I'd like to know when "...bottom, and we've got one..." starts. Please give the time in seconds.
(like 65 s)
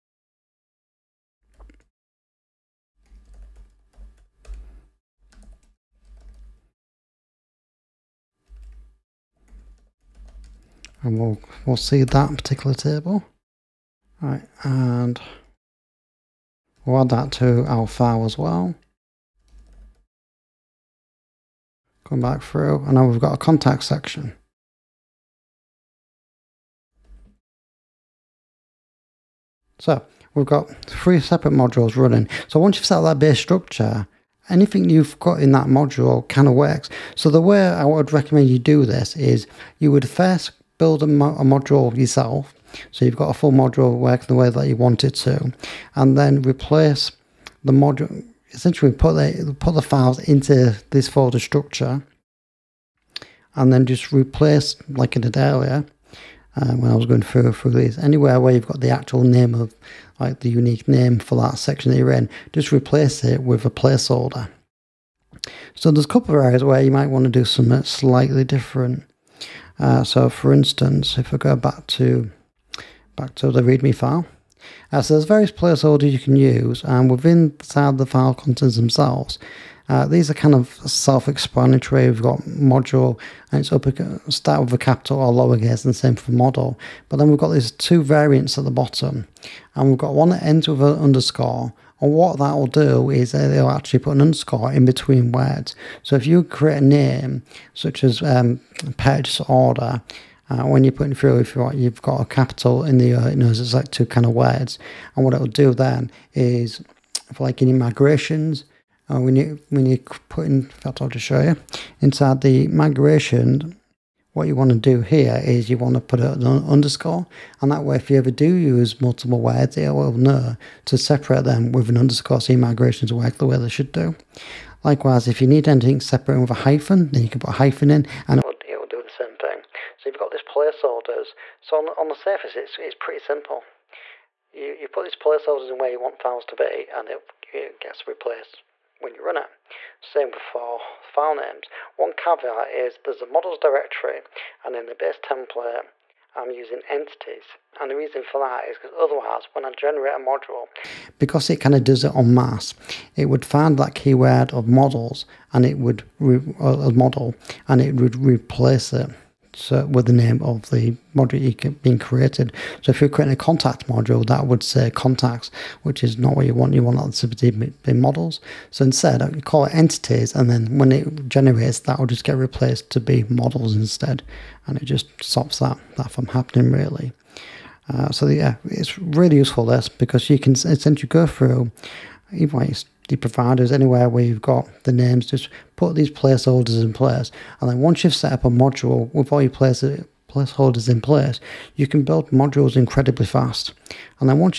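88 s.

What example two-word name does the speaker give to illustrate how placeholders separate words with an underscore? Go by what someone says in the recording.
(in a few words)
purchase order.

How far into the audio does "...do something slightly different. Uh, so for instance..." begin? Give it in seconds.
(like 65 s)
67 s.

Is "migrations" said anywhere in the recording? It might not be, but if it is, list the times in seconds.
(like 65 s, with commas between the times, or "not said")
107 s, 112 s, 122 s.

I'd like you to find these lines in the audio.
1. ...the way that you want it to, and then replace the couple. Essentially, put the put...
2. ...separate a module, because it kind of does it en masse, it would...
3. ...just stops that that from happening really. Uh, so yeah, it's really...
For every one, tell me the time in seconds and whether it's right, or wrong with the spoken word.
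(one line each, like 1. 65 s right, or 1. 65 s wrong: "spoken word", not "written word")
1. 44 s wrong: "module", not "couple"
2. 149 s wrong: "generate", not "separate"
3. 174 s right.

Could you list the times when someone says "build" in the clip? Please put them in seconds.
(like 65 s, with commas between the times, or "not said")
40 s, 192 s.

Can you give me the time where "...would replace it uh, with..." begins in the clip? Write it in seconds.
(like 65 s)
157 s.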